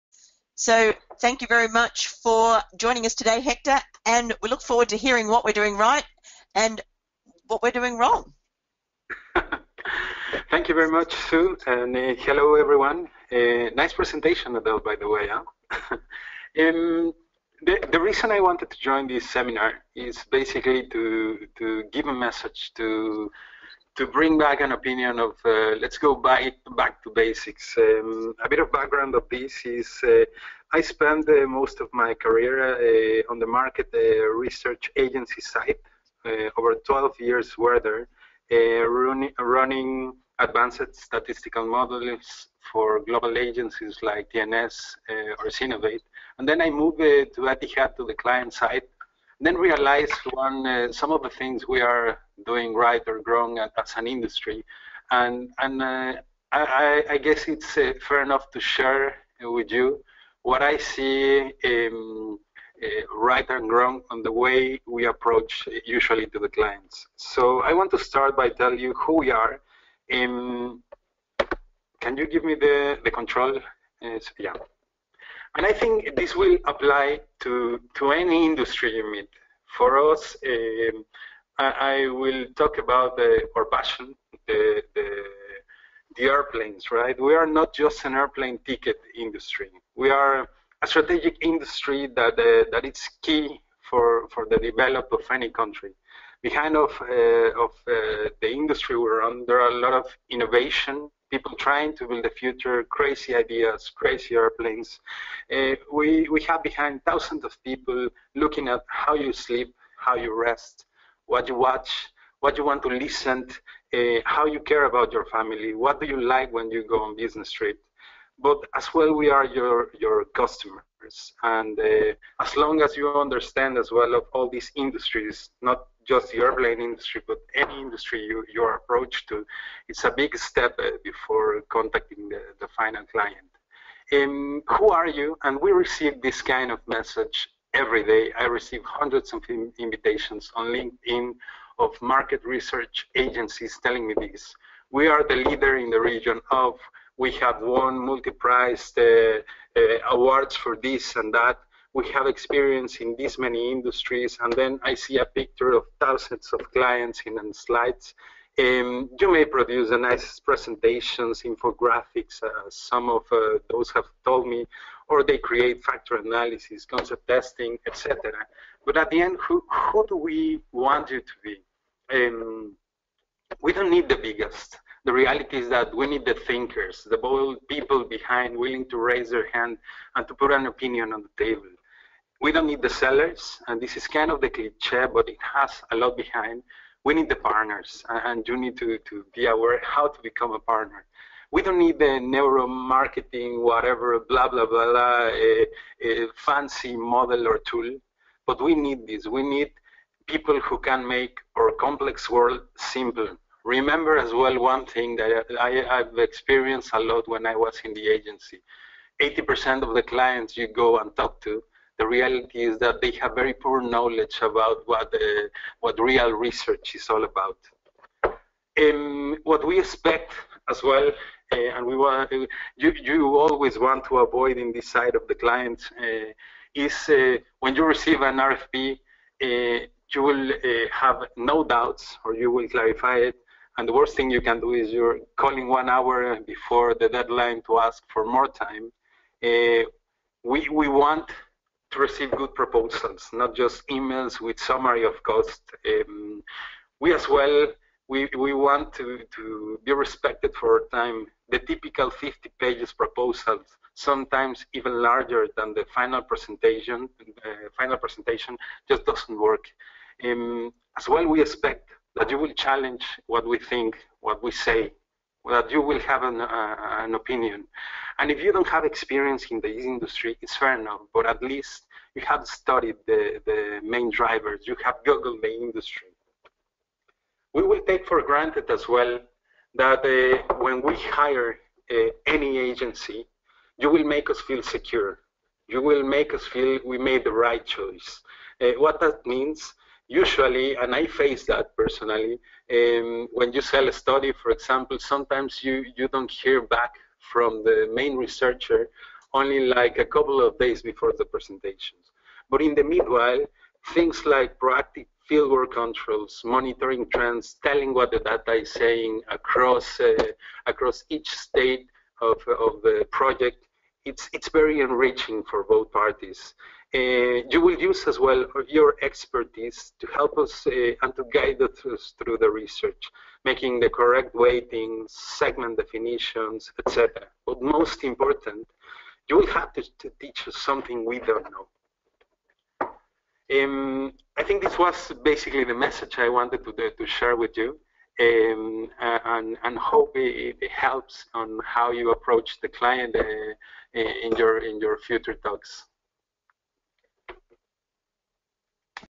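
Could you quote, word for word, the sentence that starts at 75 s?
And I think this will apply to, to any industry you meet.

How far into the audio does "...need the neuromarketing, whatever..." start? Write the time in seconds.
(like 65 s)
191 s.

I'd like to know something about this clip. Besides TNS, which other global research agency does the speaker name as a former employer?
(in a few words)
Synovate.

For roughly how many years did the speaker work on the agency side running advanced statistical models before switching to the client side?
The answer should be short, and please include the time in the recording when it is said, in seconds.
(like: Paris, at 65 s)
over 12 years, at 36 s.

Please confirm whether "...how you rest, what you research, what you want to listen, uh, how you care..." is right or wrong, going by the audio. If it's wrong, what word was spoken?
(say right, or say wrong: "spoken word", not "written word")
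wrong: "watch", not "research".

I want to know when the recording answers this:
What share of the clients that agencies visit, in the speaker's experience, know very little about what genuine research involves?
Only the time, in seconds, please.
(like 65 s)
209 s.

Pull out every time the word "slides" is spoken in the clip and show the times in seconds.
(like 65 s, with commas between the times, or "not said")
157 s.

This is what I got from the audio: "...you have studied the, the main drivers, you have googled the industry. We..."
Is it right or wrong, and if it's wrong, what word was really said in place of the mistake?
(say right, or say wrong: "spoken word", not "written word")
right.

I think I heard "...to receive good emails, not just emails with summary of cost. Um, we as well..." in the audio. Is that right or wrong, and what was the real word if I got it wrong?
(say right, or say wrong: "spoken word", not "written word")
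wrong: "proposals", not "emails".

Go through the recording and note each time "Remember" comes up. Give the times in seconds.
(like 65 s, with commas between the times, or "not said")
203 s.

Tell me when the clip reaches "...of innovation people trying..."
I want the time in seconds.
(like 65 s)
99 s.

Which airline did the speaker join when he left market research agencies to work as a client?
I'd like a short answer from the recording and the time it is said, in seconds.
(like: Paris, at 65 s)
Etihad, at 47 s.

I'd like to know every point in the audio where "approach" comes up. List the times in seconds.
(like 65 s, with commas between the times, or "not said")
65 s, 128 s, 342 s.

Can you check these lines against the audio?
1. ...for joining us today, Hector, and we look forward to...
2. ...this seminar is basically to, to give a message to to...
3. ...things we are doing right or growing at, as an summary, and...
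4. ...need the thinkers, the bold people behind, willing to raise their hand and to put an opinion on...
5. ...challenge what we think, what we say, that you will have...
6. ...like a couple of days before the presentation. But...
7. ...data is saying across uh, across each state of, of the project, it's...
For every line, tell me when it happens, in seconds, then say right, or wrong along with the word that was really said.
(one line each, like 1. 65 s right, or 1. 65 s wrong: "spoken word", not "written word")
1. 2 s right
2. 19 s right
3. 51 s wrong: "industry", not "summary"
4. 176 s right
5. 262 s right
6. 299 s right
7. 308 s right.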